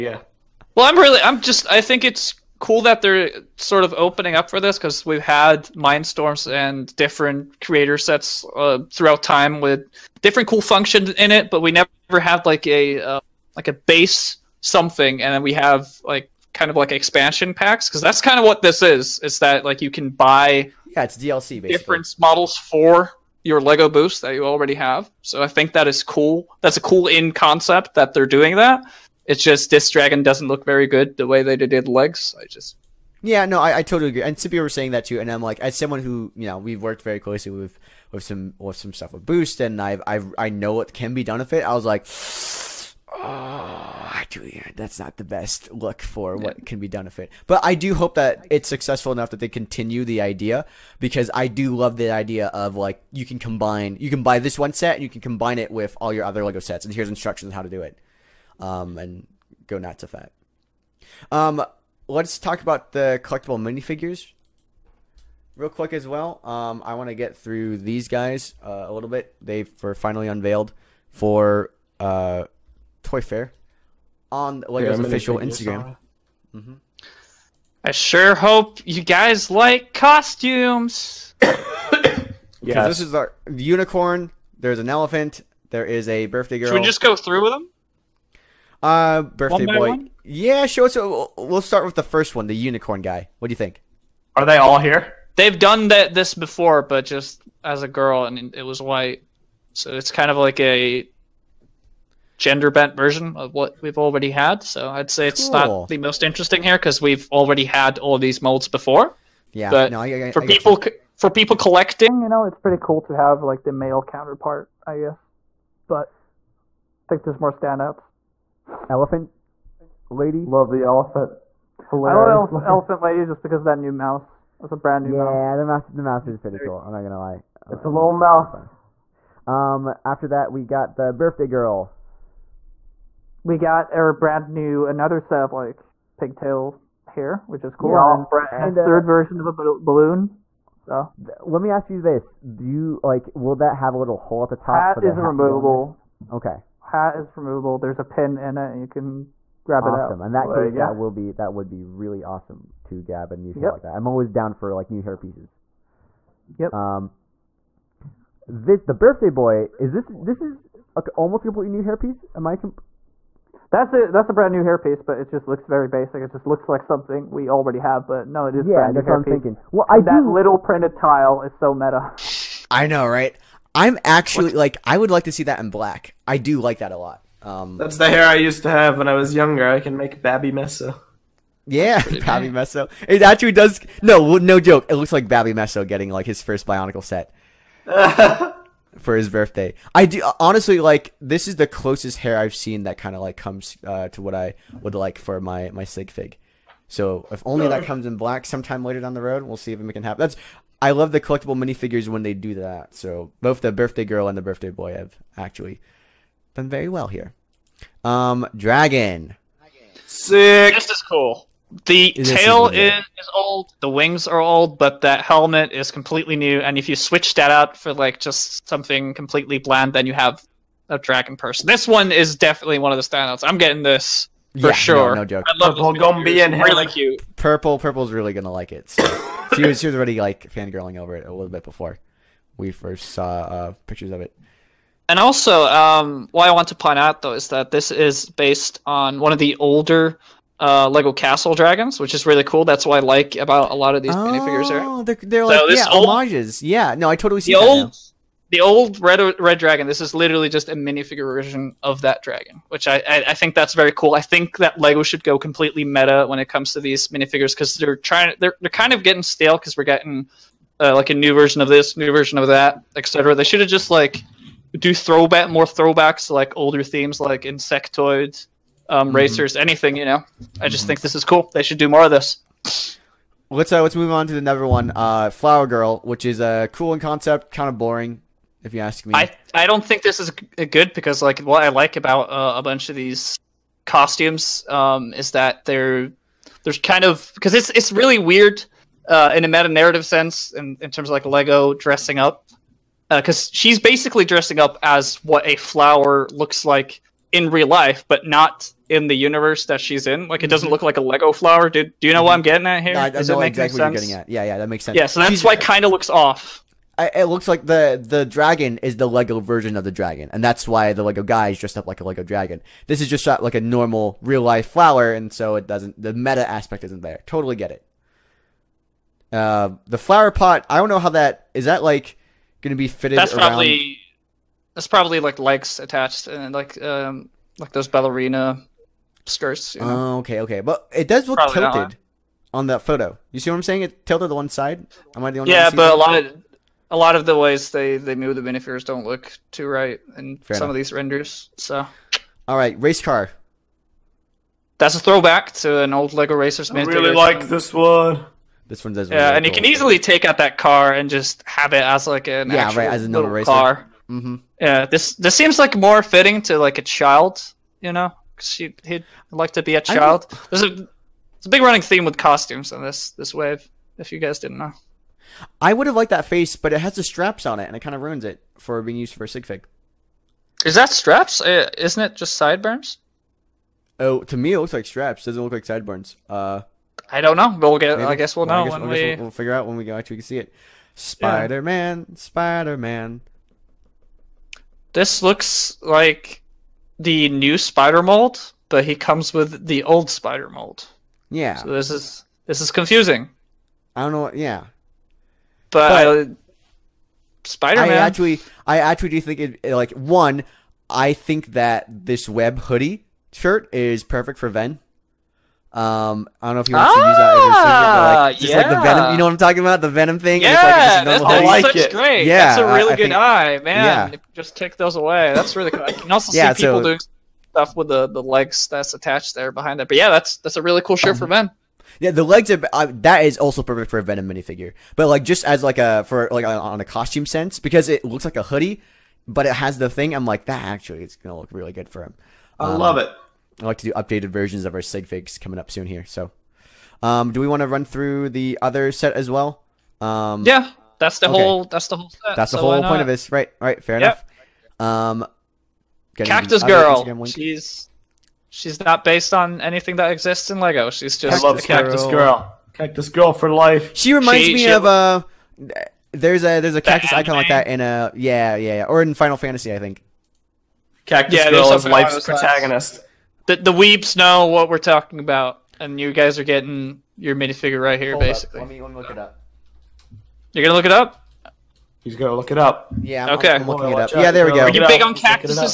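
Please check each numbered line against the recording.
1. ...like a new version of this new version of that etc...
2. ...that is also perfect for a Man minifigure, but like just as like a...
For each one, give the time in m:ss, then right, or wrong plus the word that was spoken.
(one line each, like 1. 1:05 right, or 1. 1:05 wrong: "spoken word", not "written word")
1. 4:20 right
2. 7:02 wrong: "Venom", not "Man".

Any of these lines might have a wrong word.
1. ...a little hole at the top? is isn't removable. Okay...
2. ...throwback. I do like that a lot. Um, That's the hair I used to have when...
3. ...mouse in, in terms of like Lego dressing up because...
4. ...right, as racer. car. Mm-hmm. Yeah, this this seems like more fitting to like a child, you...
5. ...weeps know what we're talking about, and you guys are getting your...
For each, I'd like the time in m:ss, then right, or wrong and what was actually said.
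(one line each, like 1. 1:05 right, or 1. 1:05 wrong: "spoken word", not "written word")
1. 2:23 right
2. 2:55 wrong: "black", not "throwback"
3. 4:50 wrong: "sense", not "mouse"
4. 5:52 right
5. 7:43 right.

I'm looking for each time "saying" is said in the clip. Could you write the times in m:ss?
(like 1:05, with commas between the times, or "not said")
0:34, 5:33.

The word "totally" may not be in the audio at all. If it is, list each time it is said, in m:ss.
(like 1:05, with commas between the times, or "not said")
0:33, 4:07, 5:17.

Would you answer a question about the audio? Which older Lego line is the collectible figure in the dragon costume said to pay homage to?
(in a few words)
Lego Castle.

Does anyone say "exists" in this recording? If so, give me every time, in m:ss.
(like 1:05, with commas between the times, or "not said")
7:30.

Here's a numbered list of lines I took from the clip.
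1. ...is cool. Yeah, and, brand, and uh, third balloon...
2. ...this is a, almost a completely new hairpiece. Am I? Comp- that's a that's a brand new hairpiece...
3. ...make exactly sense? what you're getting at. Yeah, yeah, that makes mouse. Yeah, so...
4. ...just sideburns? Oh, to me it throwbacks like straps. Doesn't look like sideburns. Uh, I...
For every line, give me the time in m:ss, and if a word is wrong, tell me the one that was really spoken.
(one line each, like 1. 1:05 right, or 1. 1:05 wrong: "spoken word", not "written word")
1. 2:17 wrong: "version", not "balloon"
2. 2:40 right
3. 5:03 wrong: "sense", not "mouse"
4. 6:12 wrong: "looks", not "throwbacks".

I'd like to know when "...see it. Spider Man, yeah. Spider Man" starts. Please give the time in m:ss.
6:20.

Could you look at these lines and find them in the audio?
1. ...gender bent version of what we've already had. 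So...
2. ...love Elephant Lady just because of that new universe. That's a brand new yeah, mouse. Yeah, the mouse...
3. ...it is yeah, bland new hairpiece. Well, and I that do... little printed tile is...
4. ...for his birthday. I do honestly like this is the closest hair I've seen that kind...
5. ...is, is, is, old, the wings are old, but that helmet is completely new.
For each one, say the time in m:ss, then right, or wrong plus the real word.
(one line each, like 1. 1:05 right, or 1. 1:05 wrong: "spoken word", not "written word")
1. 1:42 right
2. 2:02 wrong: "mouse", not "universe"
3. 2:48 wrong: "brand", not "bland"
4. 3:08 right
5. 3:32 right.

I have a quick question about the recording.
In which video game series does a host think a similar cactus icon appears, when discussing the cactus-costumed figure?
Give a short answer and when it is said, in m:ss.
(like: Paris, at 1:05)
Final Fantasy, at 7:39.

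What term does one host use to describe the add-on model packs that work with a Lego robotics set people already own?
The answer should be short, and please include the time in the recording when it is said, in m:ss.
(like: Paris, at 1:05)
DLC, at 0:21.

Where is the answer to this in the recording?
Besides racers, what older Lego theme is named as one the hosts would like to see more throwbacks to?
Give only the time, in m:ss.
4:27.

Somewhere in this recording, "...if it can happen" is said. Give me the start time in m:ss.
3:19.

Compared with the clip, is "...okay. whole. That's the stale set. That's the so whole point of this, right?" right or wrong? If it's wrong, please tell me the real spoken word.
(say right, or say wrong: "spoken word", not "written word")
wrong: "whole", not "stale".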